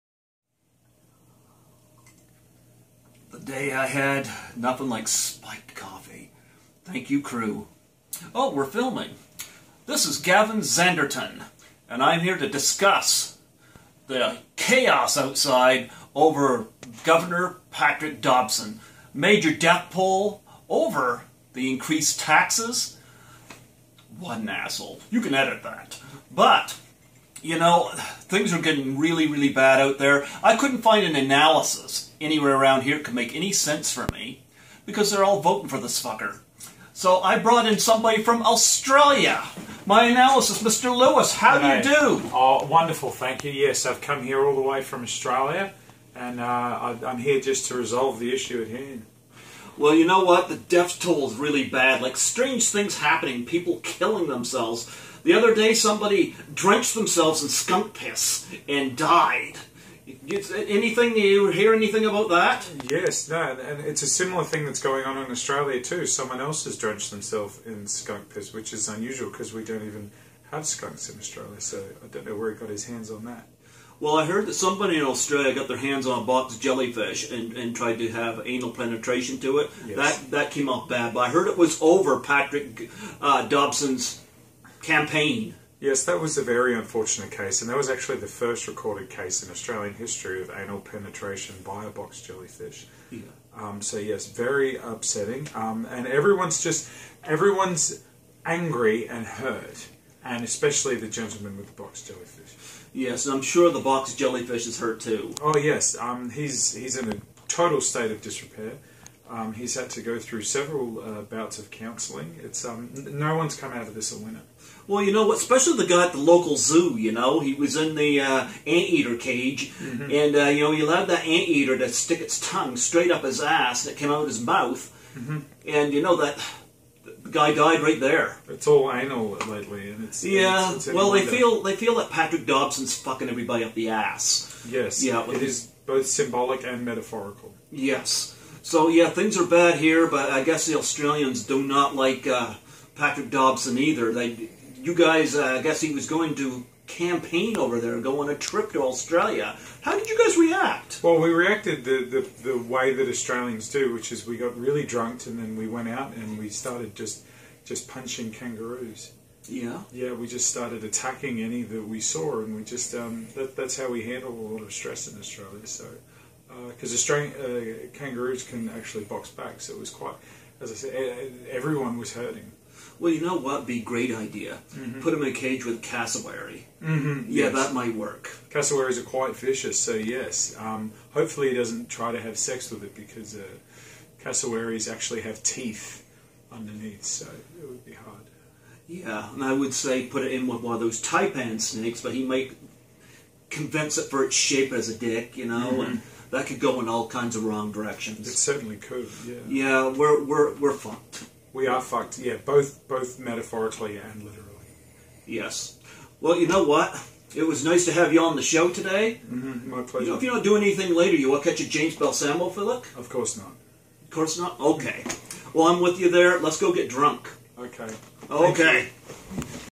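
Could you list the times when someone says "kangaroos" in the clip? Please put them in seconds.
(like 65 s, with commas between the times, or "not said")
158 s, 167 s.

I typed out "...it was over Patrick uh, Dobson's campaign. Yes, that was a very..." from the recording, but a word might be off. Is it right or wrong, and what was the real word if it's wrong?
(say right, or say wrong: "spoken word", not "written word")
right.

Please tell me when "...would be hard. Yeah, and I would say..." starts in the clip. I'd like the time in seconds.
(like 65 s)
187 s.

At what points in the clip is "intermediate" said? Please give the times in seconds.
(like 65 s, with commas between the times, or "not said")
not said.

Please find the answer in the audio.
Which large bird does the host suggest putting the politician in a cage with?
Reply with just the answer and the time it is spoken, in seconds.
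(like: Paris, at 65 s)
Cassowary, at 175 s.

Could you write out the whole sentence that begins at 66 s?
Someone else has drenched themselves in skunk piss, which is unusual because we don't even have skunks in Australia.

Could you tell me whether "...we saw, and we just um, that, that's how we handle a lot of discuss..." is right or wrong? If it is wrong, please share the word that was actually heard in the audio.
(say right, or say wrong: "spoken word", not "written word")
wrong: "stress", not "discuss".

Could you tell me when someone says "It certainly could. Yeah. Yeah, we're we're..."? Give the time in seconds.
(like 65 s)
198 s.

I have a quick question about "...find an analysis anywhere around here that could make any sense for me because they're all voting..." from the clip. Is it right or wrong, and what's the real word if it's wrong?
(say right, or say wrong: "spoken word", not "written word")
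right.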